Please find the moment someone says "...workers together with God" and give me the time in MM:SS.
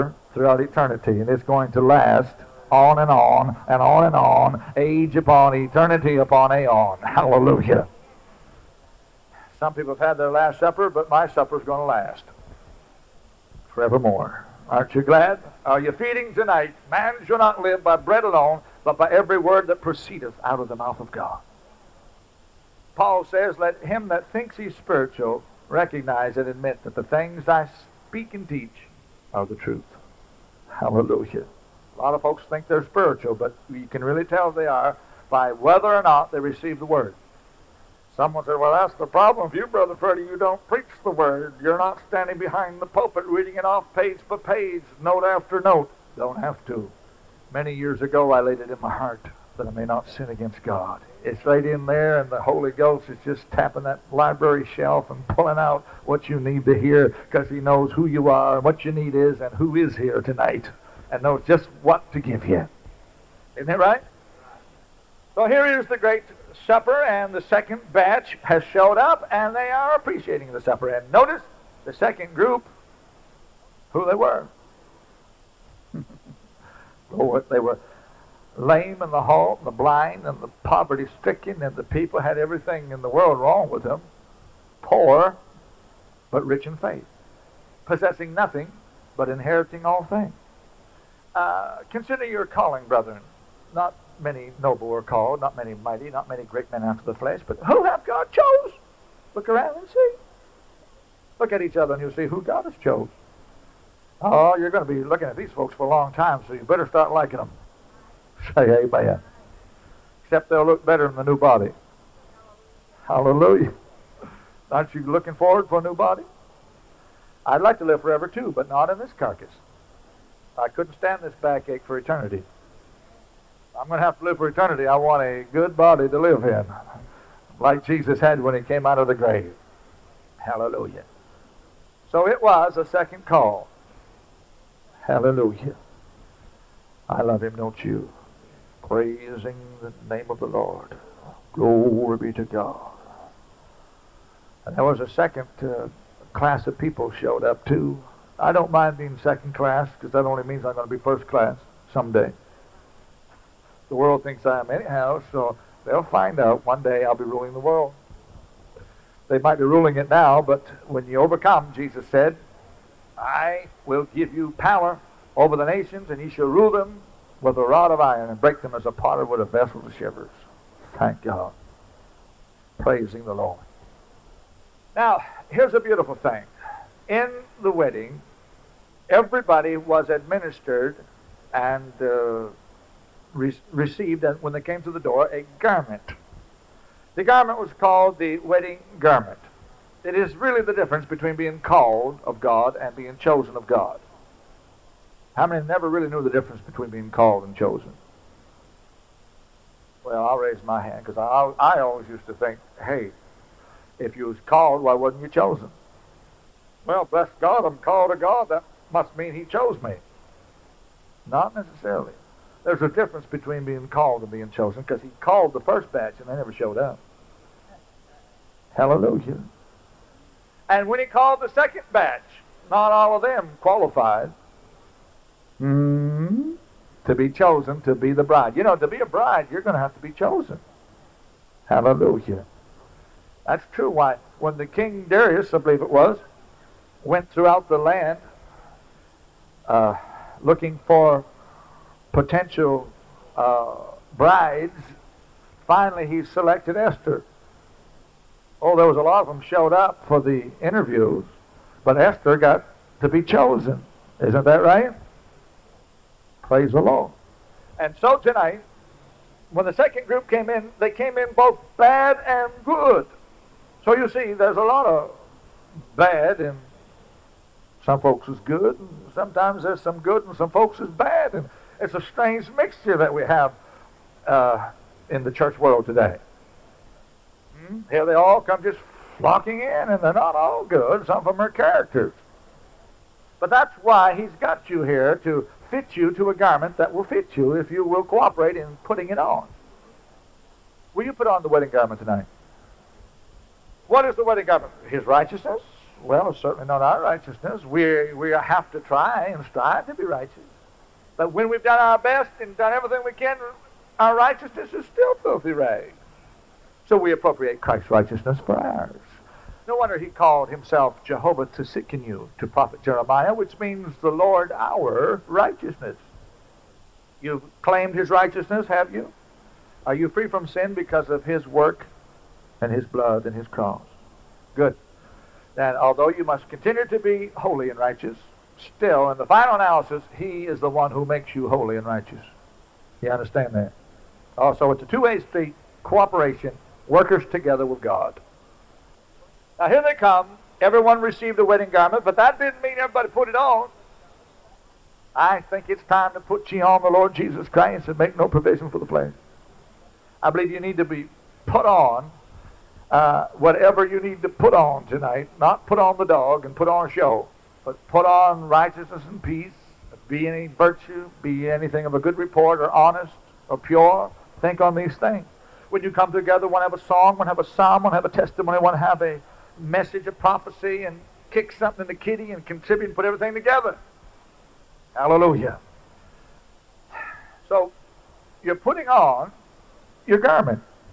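05:36.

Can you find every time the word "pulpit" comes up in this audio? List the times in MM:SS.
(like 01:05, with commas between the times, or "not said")
00:42.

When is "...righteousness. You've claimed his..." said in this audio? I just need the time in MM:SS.
05:15.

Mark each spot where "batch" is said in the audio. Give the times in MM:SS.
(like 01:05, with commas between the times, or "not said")
01:07, 03:35, 03:41.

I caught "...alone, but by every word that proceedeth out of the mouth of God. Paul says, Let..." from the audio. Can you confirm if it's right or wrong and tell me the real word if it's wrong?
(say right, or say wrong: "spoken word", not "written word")
right.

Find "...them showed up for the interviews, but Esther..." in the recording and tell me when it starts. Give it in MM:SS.
04:09.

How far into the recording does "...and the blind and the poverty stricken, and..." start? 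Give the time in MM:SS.
01:19.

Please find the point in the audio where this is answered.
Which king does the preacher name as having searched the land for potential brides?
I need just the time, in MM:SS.
03:55.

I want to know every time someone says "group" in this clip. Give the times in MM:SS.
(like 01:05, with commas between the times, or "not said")
01:12, 04:20.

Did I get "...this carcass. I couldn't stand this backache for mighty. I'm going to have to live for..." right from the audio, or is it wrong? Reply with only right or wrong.
wrong.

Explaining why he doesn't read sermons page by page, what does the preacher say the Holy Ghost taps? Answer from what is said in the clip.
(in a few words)
library shelf.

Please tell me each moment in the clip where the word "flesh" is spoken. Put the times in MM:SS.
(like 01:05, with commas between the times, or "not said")
01:37, 05:48.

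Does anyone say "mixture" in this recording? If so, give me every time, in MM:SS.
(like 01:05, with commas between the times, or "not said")
04:32.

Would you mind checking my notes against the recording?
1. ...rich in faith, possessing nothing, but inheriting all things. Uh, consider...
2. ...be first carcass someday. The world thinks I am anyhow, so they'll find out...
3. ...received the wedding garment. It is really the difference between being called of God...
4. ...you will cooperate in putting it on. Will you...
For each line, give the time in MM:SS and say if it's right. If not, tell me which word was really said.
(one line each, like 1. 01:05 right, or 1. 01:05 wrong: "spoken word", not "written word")
1. 01:26 right
2. 02:30 wrong: "class", not "carcass"
3. 03:07 wrong: "called", not "received"
4. 04:47 right.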